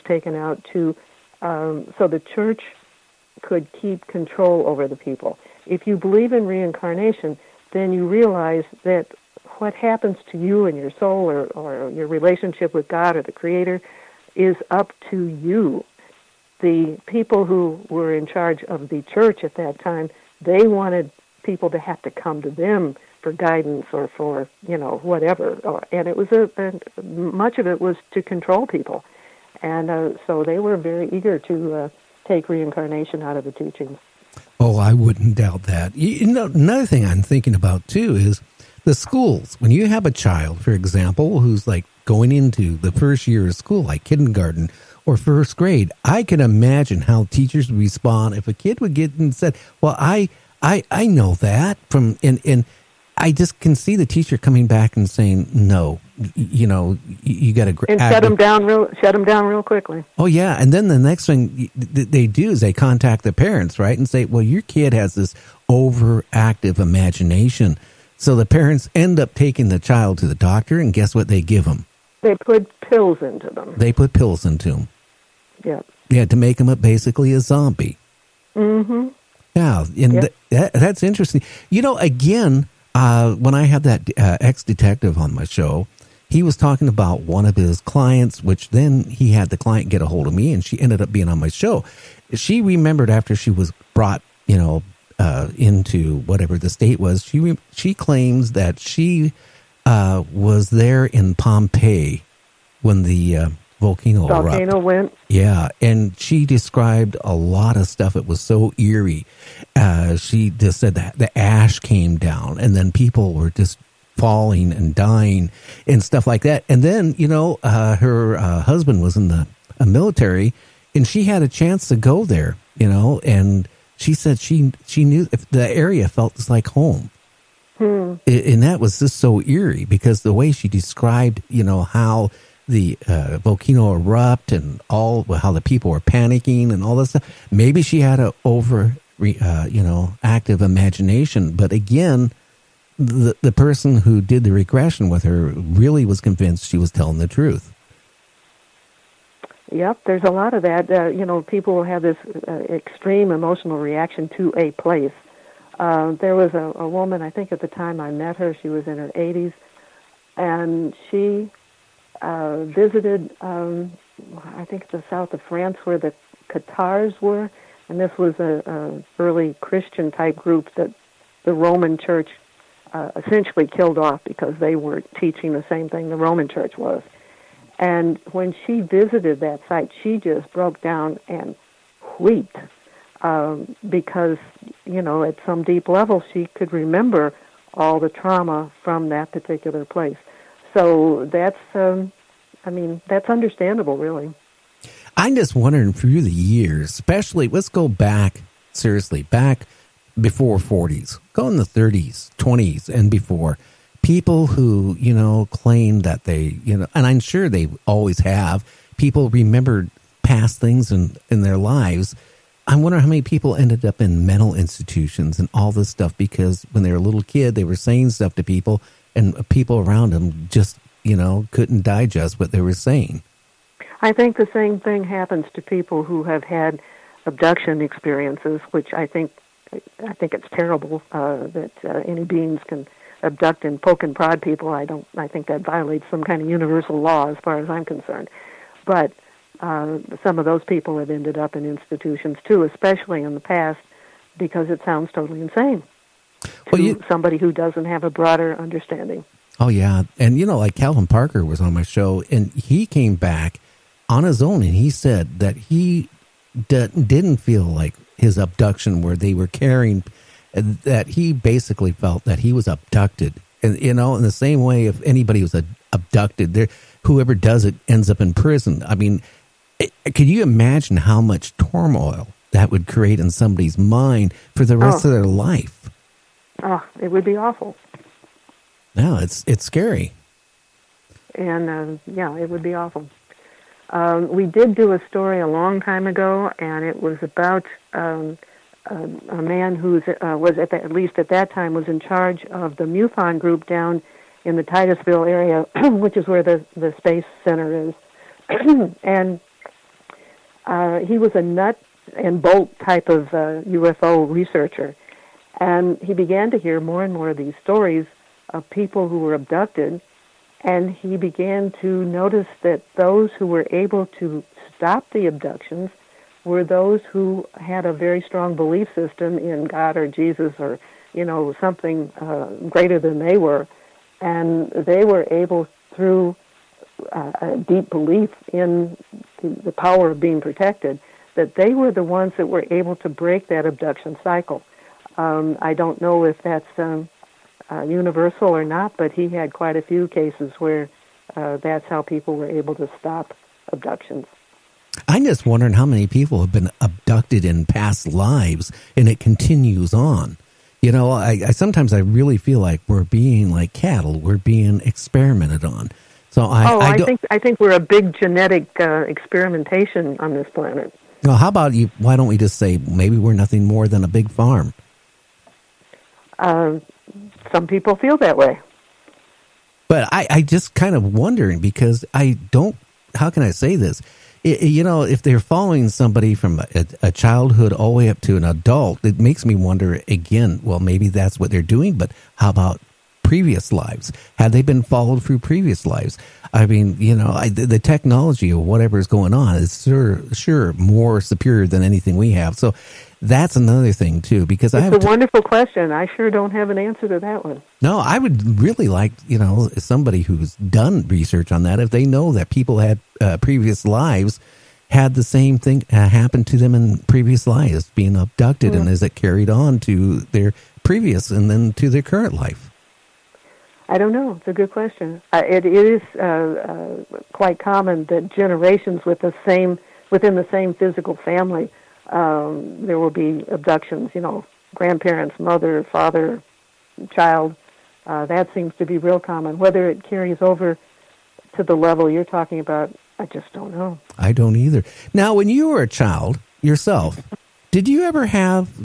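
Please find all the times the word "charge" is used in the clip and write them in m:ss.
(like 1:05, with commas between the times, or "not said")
0:18, 4:51.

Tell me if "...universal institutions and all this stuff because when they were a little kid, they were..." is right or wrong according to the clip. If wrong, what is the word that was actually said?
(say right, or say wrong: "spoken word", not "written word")
wrong: "mental", not "universal".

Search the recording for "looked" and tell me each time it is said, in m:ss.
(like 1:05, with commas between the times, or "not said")
not said.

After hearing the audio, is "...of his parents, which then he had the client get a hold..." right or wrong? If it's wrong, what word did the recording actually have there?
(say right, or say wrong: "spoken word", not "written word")
wrong: "clients", not "parents".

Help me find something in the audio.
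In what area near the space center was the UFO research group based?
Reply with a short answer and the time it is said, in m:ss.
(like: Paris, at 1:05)
Titusville, at 4:54.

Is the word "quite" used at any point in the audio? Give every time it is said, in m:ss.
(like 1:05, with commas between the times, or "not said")
5:39, 6:57.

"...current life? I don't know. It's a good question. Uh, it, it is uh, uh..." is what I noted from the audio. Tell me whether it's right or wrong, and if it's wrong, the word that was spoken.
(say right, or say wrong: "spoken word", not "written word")
right.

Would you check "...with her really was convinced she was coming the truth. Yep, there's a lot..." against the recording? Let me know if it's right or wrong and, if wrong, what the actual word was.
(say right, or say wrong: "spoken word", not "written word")
wrong: "telling", not "coming".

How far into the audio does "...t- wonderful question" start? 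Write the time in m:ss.
6:34.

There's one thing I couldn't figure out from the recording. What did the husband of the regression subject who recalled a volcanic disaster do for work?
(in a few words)
military.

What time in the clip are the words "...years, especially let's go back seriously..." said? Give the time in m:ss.
3:16.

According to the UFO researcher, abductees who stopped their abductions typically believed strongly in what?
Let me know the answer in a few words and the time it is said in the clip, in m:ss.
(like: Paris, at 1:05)
God or Jesus, at 5:19.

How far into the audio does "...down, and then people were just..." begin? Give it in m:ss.
1:52.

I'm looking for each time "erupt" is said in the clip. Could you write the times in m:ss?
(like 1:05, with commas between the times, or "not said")
1:44, 2:13.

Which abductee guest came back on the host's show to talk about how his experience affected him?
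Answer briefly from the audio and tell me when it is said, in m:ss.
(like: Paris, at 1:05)
Calvin Parker, at 4:10.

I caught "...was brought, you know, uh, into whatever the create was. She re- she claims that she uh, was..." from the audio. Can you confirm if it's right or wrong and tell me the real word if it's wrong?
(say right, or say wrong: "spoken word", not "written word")
wrong: "state", not "create".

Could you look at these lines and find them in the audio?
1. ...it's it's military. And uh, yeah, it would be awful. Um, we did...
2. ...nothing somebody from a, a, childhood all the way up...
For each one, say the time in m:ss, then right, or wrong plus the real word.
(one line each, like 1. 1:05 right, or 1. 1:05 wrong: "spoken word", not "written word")
1. 4:39 wrong: "scary", not "military"
2. 6:15 wrong: "following", not "nothing".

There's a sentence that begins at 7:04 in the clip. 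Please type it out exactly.
You know, grandparents, mother, father, child.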